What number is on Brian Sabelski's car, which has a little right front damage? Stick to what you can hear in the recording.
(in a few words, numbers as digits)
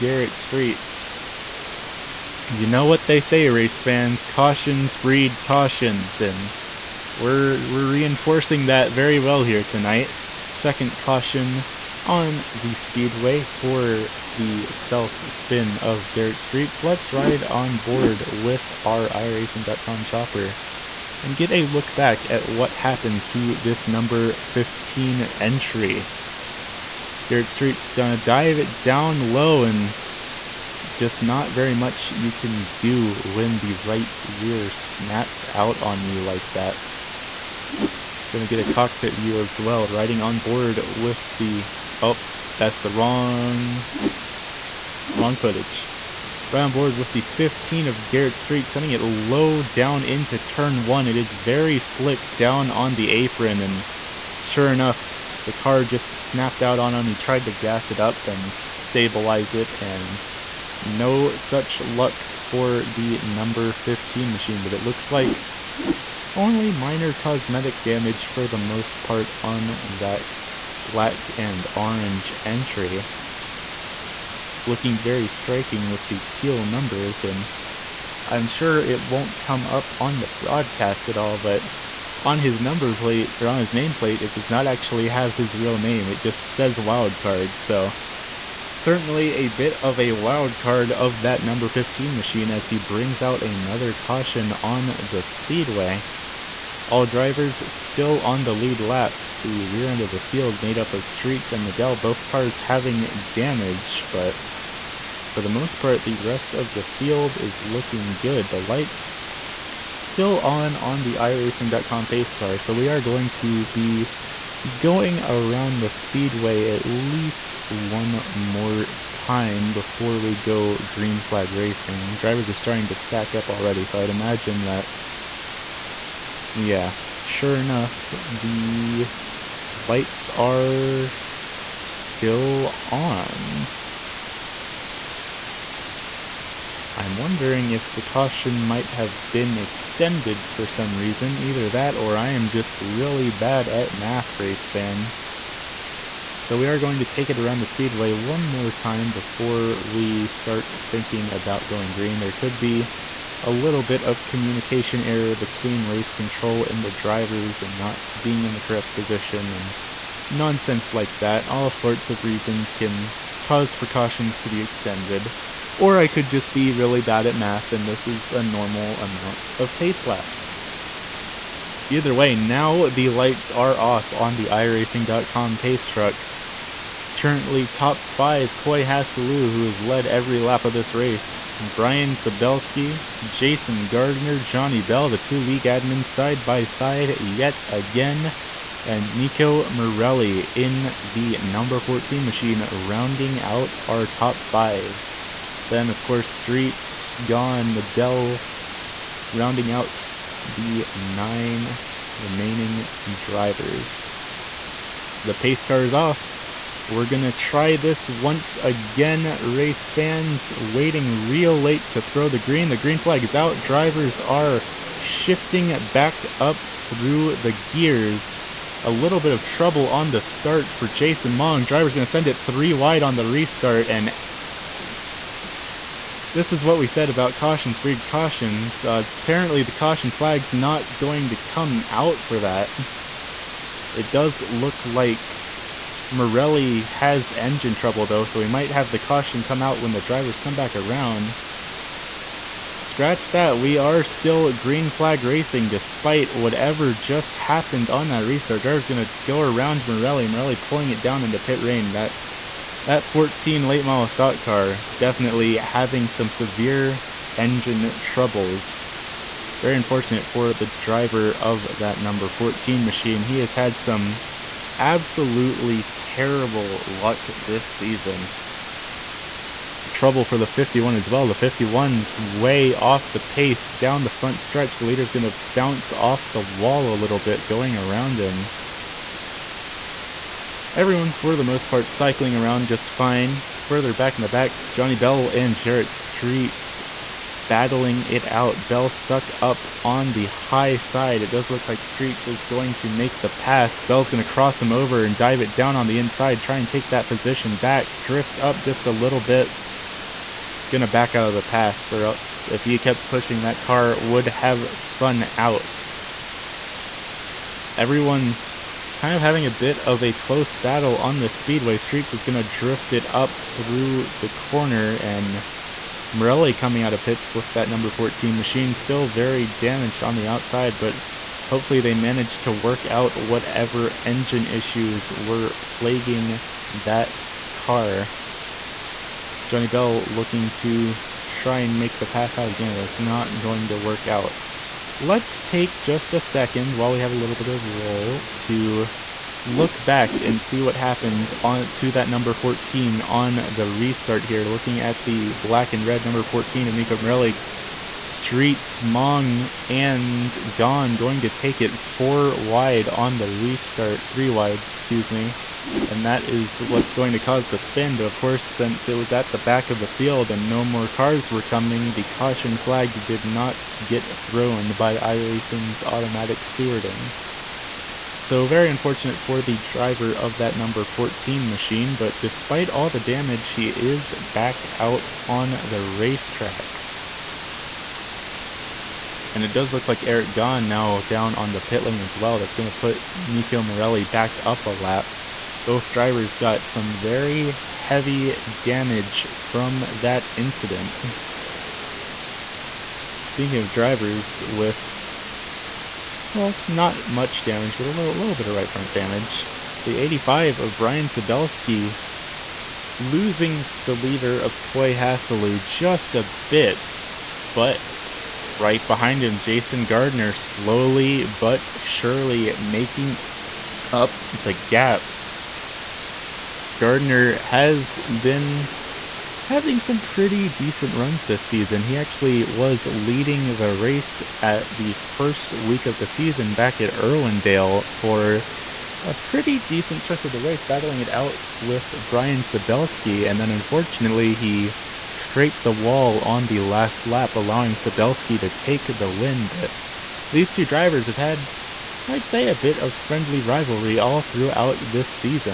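85.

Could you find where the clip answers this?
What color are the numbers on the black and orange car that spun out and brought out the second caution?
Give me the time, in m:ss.
1:16.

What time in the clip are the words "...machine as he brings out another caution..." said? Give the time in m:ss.
1:32.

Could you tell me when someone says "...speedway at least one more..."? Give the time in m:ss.
1:55.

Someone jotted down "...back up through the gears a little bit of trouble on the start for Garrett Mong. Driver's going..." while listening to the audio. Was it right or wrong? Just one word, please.
wrong.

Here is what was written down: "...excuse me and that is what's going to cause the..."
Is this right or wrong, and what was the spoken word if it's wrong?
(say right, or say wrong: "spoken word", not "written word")
right.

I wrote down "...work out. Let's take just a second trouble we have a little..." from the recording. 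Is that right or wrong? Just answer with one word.
wrong.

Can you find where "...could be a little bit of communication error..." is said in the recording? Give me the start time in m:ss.
2:32.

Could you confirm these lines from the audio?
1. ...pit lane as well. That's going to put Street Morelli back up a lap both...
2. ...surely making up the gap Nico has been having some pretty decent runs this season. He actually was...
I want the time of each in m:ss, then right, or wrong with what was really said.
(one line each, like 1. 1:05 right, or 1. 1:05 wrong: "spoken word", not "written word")
1. 6:21 wrong: "Nico", not "Street"
2. 6:51 wrong: "Gardner", not "Nico".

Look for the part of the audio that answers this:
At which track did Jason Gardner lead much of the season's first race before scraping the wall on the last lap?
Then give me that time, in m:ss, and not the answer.
7:06.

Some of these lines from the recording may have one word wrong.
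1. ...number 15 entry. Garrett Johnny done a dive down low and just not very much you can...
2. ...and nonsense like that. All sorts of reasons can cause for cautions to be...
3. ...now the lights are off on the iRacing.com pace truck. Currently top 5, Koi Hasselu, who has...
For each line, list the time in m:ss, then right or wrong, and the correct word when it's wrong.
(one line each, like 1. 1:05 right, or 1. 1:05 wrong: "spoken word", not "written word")
1. 0:23 wrong: "Streets", not "Johnny"
2. 2:39 right
3. 2:52 right.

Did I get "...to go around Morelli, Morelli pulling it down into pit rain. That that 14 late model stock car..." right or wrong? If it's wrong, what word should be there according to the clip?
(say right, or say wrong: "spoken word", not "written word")
right.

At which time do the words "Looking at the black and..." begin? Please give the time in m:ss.
5:44.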